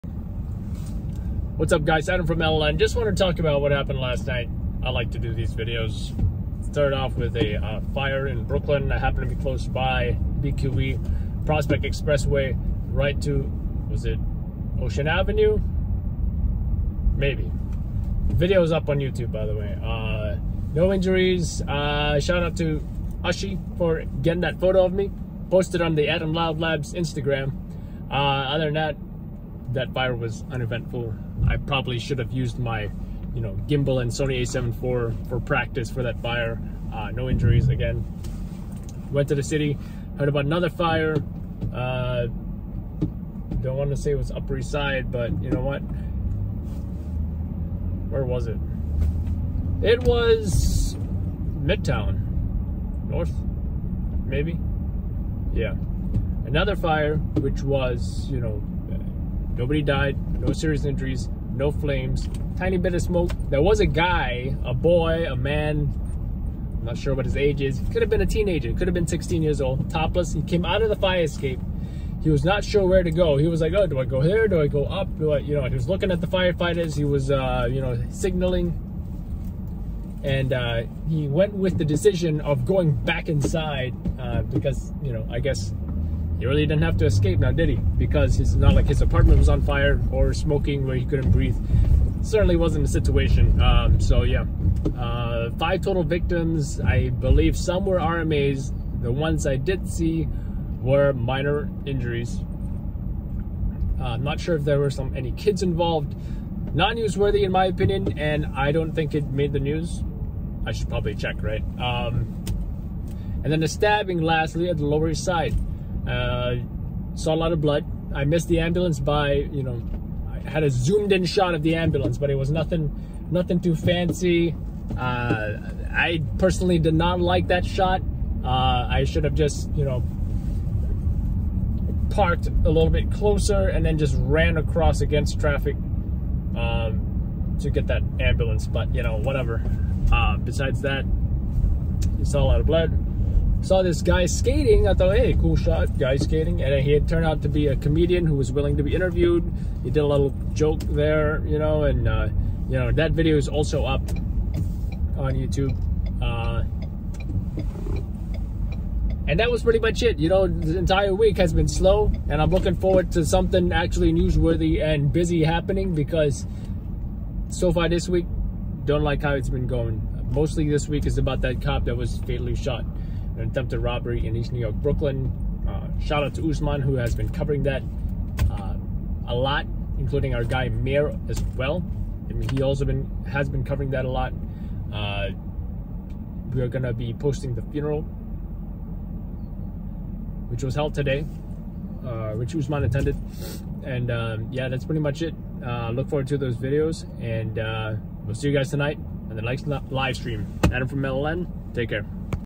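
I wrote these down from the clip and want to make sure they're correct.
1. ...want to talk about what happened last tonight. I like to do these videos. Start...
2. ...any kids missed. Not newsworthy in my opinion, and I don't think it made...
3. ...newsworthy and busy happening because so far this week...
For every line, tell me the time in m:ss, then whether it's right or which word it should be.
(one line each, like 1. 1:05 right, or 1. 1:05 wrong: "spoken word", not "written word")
1. 0:02 wrong: "night", not "tonight"
2. 1:45 wrong: "involved", not "missed"
3. 2:44 right.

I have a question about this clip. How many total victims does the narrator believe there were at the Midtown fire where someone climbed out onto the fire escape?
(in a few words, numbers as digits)
5.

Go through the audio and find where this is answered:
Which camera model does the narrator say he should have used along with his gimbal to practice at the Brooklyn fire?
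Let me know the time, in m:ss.
0:34.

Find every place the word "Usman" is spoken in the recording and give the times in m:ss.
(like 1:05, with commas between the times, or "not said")
2:56, 3:12.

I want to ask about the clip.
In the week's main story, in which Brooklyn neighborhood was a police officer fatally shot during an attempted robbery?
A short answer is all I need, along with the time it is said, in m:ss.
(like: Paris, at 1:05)
East New York, at 2:54.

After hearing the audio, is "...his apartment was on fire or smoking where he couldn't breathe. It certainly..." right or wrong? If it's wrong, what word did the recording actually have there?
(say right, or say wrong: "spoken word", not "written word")
right.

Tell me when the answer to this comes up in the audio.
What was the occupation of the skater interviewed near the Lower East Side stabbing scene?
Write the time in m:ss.
2:27.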